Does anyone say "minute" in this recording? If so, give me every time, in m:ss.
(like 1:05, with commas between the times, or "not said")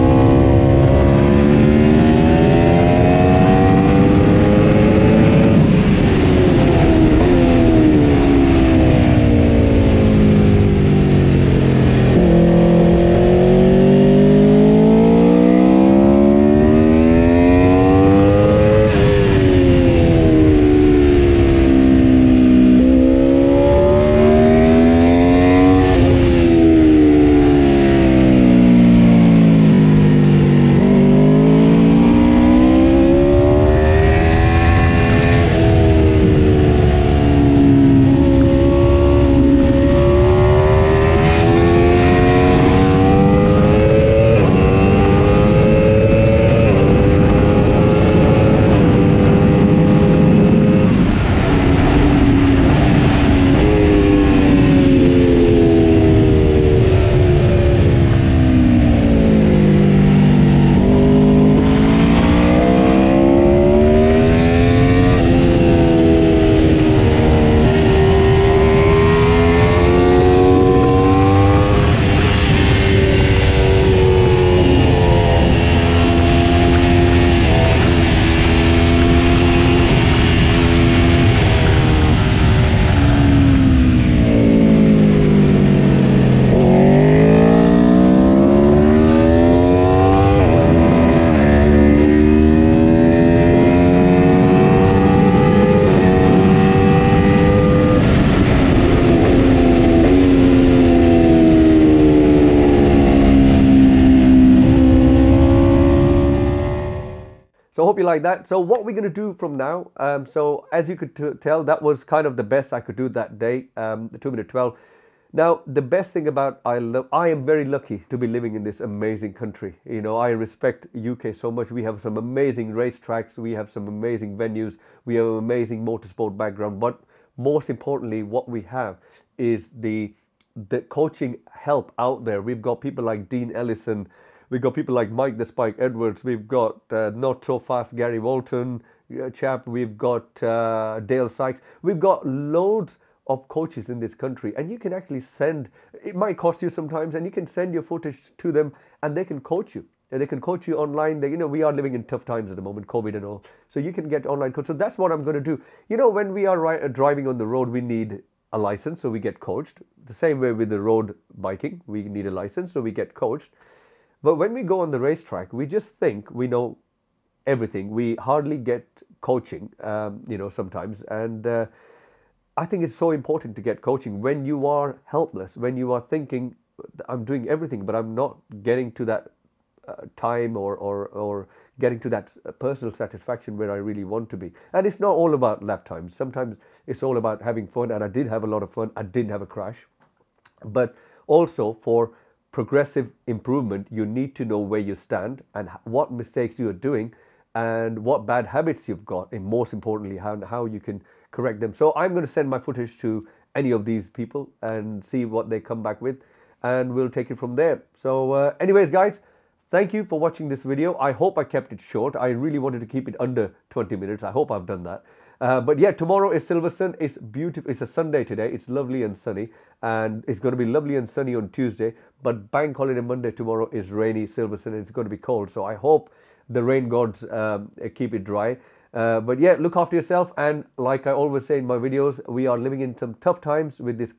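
1:54, 3:33.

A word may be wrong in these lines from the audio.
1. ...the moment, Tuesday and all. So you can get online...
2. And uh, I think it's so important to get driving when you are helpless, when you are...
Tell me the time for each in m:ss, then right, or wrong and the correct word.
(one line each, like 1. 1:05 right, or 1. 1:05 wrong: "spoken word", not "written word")
1. 2:32 wrong: "COVID", not "Tuesday"
2. 2:51 wrong: "coaching", not "driving".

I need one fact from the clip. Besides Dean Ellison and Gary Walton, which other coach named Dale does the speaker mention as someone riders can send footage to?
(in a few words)
Dale Sykes.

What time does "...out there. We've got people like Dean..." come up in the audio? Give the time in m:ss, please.
2:11.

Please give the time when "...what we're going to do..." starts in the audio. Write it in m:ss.
1:48.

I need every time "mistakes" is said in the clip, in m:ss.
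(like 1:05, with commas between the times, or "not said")
3:16.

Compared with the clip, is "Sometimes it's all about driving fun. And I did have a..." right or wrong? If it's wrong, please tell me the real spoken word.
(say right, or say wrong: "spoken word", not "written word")
wrong: "having", not "driving".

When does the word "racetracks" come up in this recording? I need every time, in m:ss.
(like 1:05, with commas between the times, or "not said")
2:02, 2:44.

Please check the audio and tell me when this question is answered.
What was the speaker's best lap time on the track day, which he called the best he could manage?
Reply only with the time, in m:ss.
1:54.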